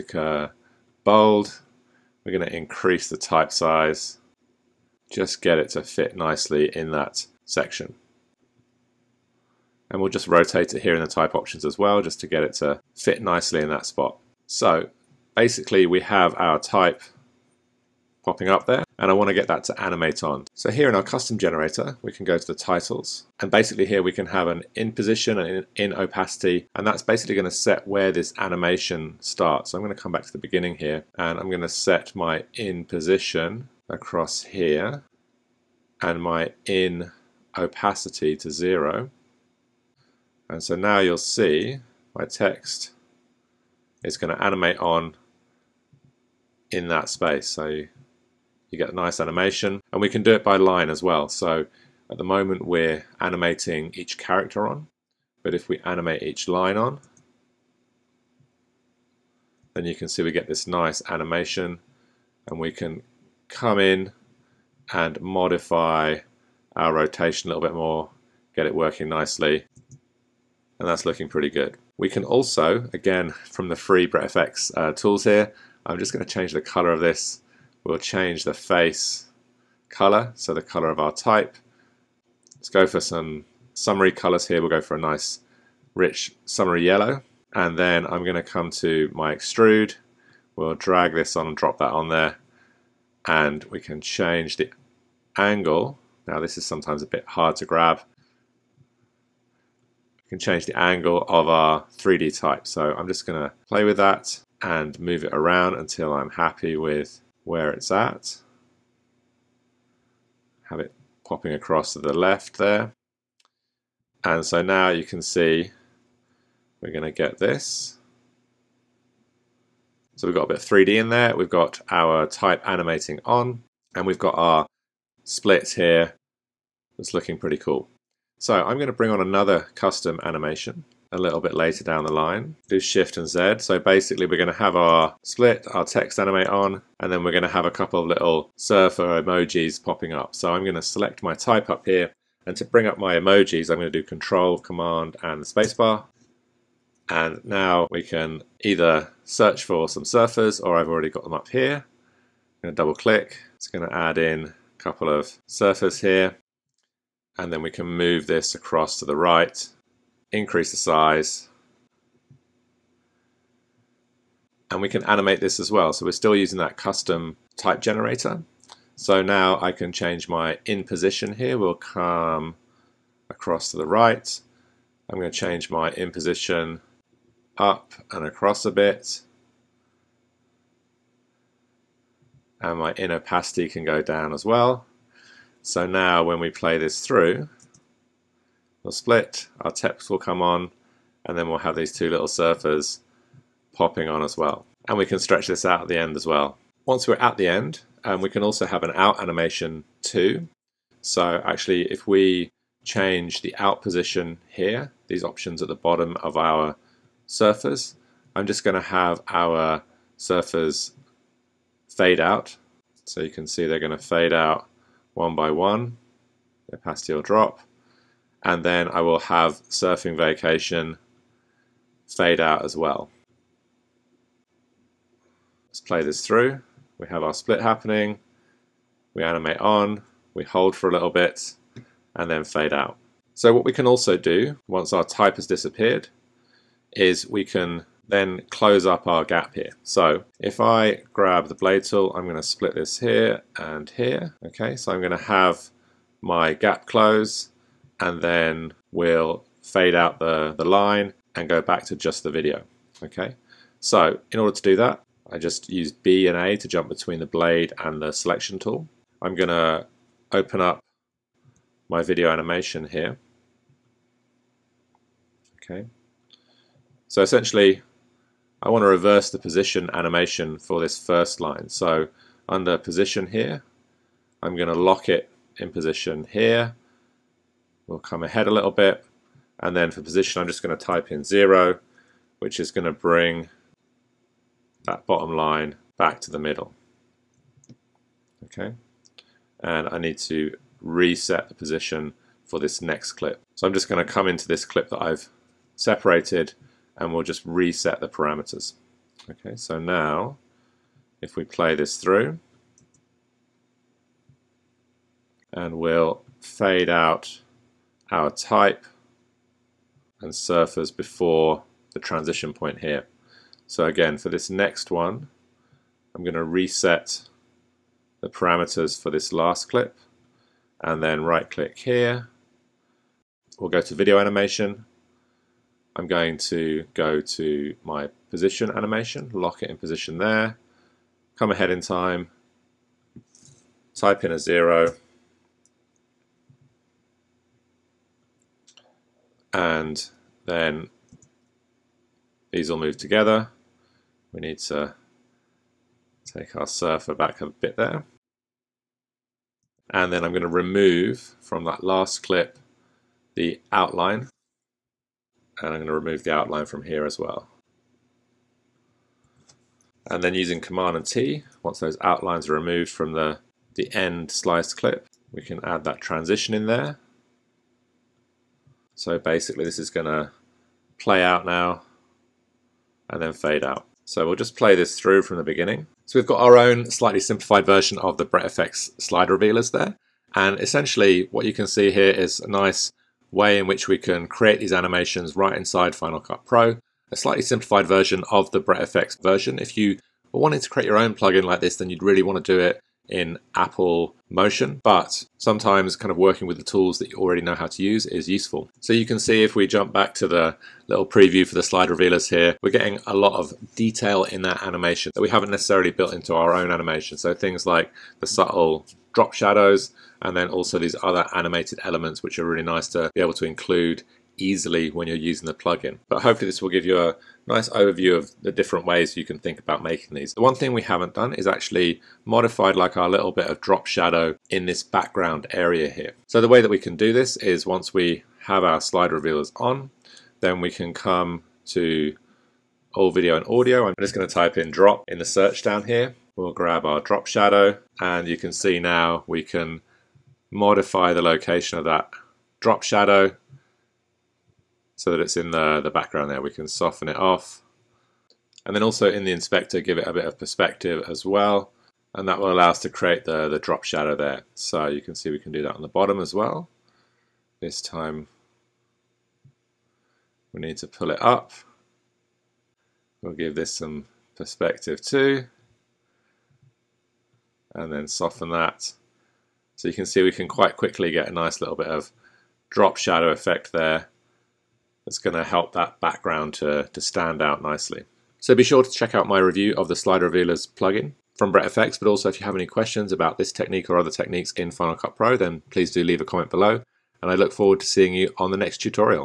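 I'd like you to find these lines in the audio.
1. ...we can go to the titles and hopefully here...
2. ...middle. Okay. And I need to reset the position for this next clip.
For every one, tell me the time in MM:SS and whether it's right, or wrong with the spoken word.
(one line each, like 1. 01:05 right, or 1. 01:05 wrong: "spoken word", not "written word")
1. 00:22 wrong: "basically", not "hopefully"
2. 04:46 right.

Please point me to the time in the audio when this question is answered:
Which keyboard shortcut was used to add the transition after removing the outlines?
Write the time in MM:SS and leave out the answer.
06:00.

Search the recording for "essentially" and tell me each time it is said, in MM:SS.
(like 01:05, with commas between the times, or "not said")
04:27, 06:20.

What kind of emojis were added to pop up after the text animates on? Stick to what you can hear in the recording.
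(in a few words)
Surfer emojis.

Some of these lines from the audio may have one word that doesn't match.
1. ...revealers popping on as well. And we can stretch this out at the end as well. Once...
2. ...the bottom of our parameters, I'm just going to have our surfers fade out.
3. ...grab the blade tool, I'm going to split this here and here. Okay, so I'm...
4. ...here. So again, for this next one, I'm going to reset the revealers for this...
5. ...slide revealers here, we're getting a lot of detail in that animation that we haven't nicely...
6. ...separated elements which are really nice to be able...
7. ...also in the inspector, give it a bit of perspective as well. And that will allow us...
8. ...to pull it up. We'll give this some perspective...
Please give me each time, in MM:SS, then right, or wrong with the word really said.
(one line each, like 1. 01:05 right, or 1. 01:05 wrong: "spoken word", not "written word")
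1. 03:12 wrong: "surfers", not "revealers"
2. 03:25 wrong: "surfers", not "parameters"
3. 04:01 right
4. 05:12 wrong: "parameters", not "revealers"
5. 06:41 wrong: "necessarily", not "nicely"
6. 06:51 wrong: "animated", not "separated"
7. 07:28 right
8. 07:40 right.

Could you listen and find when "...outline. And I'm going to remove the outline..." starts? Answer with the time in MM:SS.
05:53.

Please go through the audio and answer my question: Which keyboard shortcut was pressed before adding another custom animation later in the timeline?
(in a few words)
Shift and Z.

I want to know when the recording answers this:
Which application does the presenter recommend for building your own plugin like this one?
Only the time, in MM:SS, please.
06:33.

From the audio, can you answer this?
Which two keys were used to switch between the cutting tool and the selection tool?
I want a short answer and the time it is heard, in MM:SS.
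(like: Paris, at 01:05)
B and A, at 04:15.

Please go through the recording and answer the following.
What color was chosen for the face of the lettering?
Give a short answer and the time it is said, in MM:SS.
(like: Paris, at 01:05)
Yellow, at 01:26.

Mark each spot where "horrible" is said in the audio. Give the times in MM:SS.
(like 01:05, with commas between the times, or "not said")
not said.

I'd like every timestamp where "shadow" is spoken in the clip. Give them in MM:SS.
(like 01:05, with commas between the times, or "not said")
06:49, 07:03, 07:17, 07:22, 07:33, 07:52.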